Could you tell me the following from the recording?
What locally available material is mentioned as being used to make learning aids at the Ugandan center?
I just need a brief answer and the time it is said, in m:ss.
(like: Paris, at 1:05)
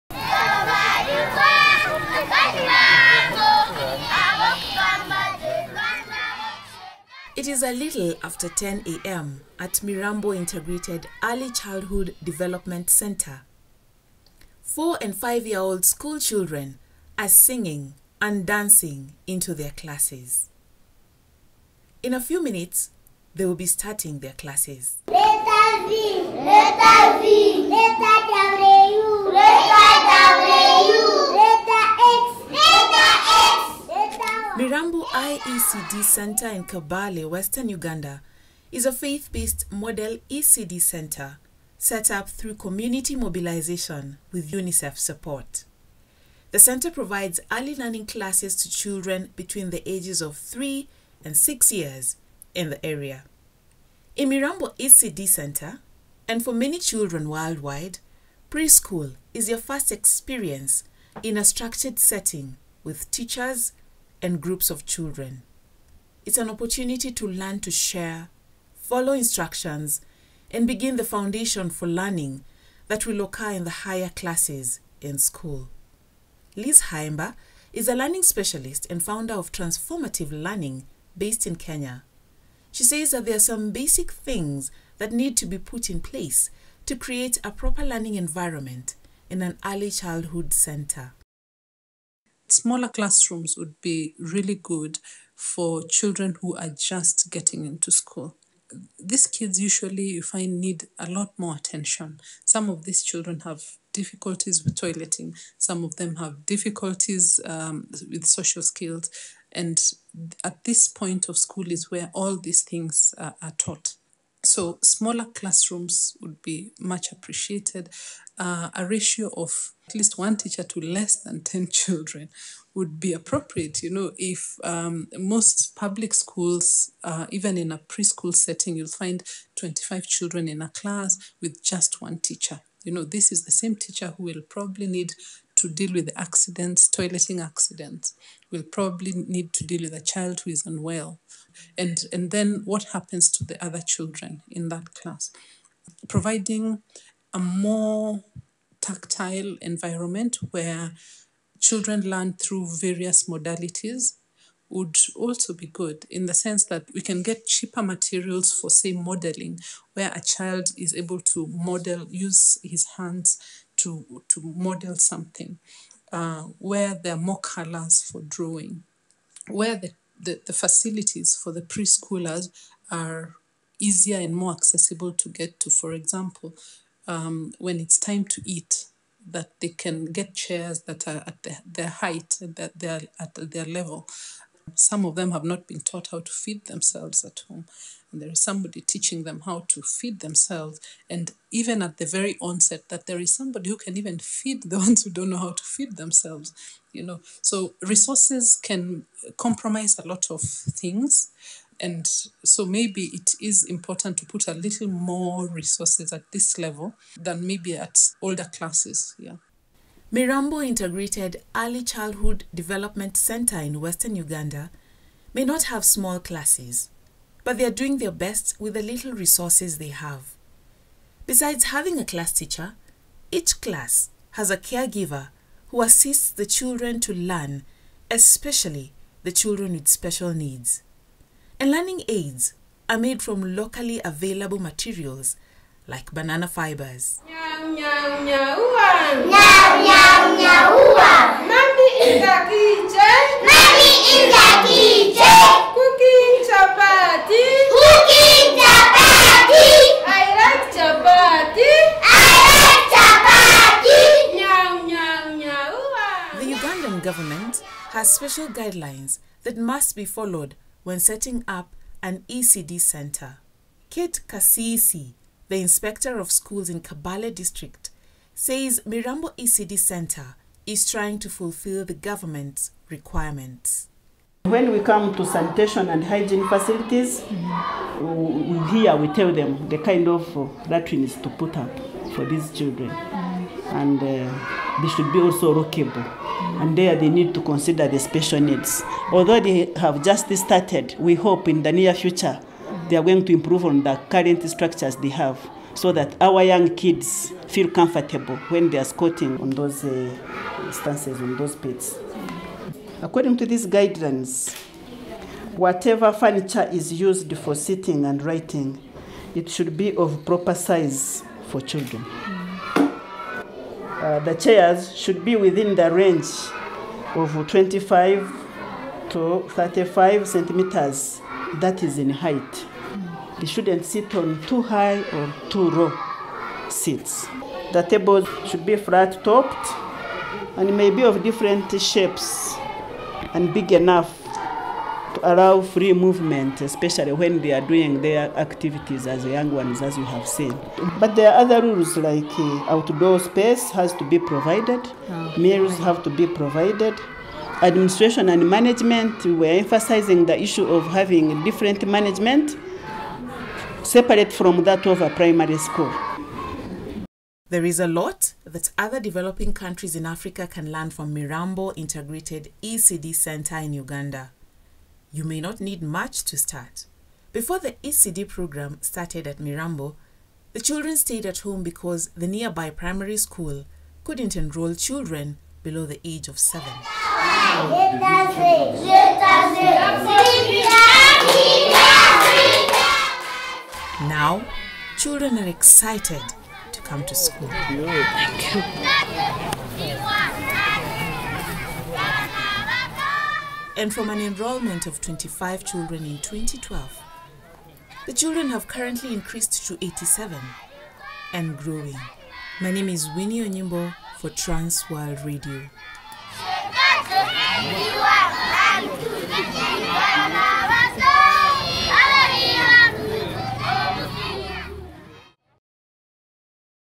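Banana fibers, at 3:56.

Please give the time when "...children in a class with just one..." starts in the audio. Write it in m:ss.
2:10.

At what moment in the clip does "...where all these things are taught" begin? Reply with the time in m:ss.
1:51.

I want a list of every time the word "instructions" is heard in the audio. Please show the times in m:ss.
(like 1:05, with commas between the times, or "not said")
1:09.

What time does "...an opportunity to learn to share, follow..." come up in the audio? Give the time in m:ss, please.
1:06.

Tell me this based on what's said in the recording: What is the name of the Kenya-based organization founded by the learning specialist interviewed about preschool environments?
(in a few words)
Transformative Learning.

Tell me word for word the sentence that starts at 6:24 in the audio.
Now, children are excited come to school.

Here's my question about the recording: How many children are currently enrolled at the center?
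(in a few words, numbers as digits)
87.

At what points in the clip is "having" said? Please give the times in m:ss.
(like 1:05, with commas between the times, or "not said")
3:41, 5:50.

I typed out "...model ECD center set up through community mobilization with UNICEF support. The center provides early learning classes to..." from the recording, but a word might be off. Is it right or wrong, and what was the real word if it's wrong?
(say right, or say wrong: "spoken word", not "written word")
right.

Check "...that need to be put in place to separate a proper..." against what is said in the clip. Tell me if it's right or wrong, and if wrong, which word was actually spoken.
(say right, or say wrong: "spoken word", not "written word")
wrong: "create", not "separate".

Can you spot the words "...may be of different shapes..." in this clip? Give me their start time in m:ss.
5:30.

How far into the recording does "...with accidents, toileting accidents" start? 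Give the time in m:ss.
2:15.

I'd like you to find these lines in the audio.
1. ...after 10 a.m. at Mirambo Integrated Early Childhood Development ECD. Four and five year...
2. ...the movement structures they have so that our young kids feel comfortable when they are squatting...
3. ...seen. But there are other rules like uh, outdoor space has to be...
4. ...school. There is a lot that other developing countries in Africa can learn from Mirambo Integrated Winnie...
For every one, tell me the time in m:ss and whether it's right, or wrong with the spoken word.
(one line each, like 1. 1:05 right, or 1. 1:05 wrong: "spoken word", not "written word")
1. 0:08 wrong: "Center", not "ECD"
2. 4:53 wrong: "current", not "movement"
3. 5:40 right
4. 5:55 wrong: "ECD", not "Winnie".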